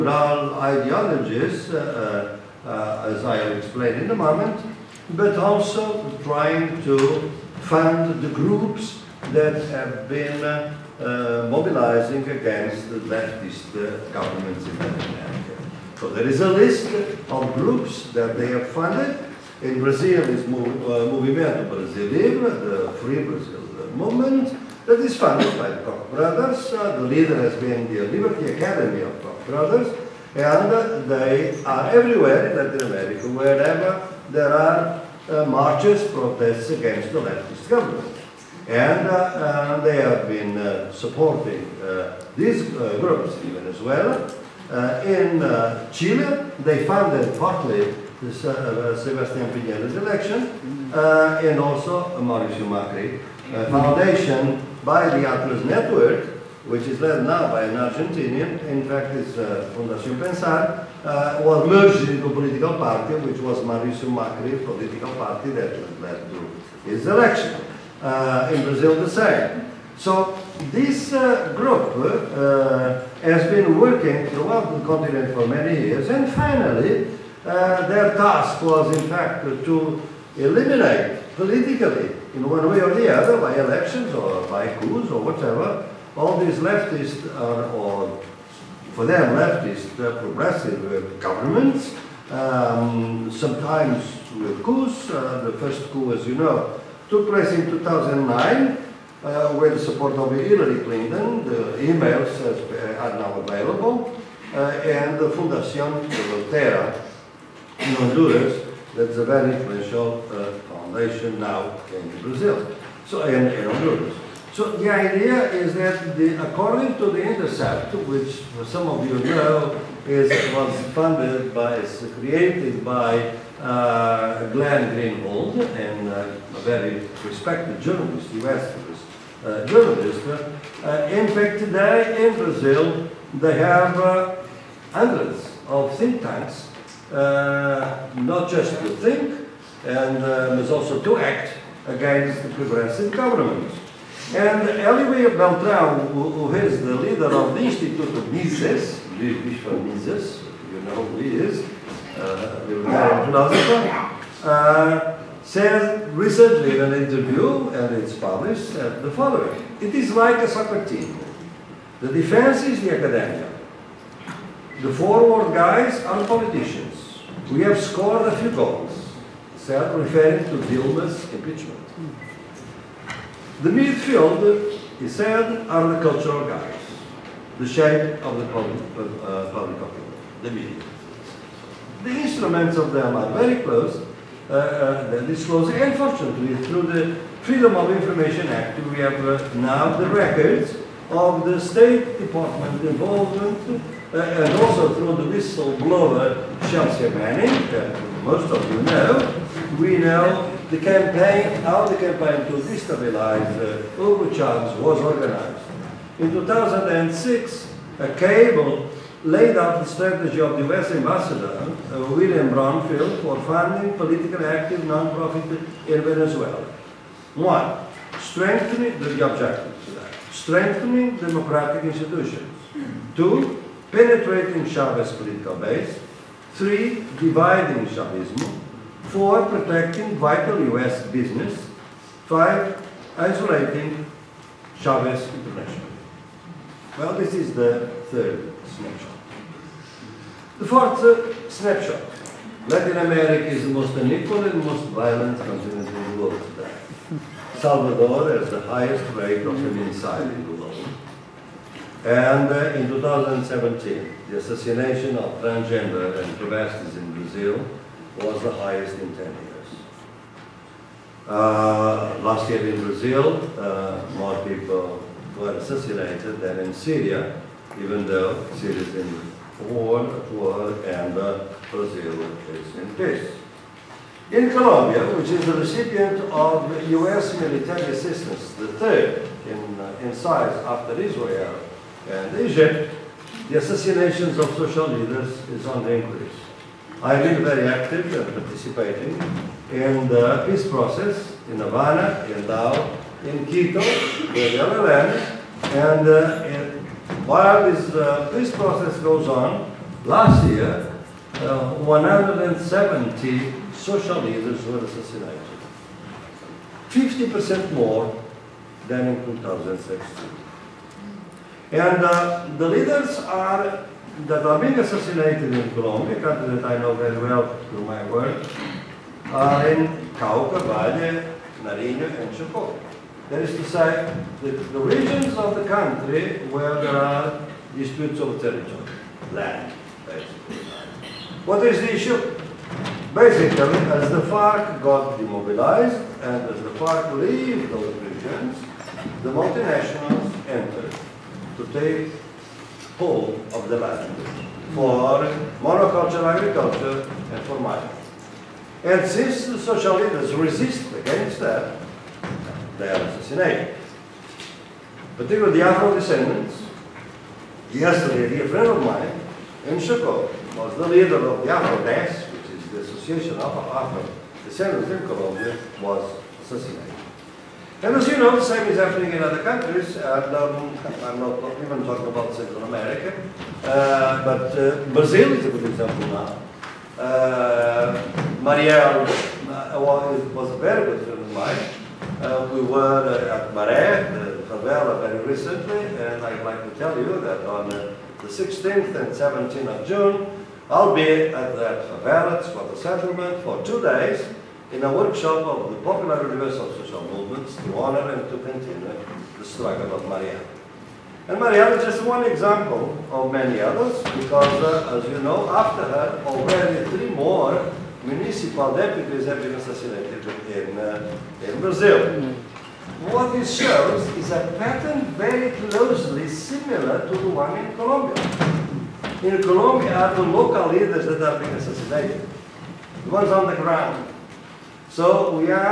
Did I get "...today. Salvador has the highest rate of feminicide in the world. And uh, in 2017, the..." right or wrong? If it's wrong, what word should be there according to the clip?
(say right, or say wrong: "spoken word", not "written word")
right.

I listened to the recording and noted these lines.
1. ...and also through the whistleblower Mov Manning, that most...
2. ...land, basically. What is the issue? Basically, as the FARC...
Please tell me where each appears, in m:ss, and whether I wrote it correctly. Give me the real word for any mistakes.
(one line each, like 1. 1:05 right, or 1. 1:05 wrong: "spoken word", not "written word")
1. 3:14 wrong: "Chelsea", not "Mov"
2. 5:29 right.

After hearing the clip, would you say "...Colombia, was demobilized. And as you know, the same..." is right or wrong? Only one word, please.
wrong.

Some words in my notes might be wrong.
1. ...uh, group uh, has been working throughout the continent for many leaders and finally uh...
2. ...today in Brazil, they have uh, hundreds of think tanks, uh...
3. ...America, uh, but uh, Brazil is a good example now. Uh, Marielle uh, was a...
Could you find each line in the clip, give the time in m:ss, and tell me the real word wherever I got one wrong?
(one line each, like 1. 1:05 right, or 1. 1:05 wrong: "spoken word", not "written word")
1. 1:11 wrong: "years", not "leaders"
2. 2:11 right
3. 6:12 right.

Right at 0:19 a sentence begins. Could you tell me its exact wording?
In Brazil is Mov uh, Movimento Brasil Livre, the Free Brazil movement that is funded by the Koch brothers.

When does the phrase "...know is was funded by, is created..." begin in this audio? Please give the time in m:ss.
1:59.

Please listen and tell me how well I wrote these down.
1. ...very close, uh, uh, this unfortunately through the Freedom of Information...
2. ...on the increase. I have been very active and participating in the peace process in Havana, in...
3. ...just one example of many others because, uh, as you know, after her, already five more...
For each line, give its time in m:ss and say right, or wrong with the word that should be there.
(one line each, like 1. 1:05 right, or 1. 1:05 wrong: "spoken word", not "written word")
1. 3:03 right
2. 4:45 right
3. 6:41 wrong: "three", not "five".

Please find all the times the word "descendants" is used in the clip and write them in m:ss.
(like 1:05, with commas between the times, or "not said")
5:55, 6:03.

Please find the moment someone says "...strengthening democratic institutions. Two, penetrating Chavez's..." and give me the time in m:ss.
3:40.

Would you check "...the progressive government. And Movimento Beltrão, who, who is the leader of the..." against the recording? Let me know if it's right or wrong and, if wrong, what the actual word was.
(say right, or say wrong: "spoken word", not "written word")
wrong: "Hélio", not "Movimento".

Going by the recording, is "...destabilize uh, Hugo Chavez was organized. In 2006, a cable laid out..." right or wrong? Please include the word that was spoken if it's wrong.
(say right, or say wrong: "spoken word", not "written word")
right.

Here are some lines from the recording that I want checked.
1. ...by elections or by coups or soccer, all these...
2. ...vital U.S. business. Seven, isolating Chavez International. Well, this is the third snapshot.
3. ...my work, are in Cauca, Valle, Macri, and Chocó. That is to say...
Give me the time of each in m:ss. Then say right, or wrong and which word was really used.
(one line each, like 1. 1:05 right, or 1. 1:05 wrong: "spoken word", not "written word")
1. 1:23 wrong: "whatever", not "soccer"
2. 3:50 wrong: "Five", not "Seven"
3. 5:17 wrong: "Nariño", not "Macri".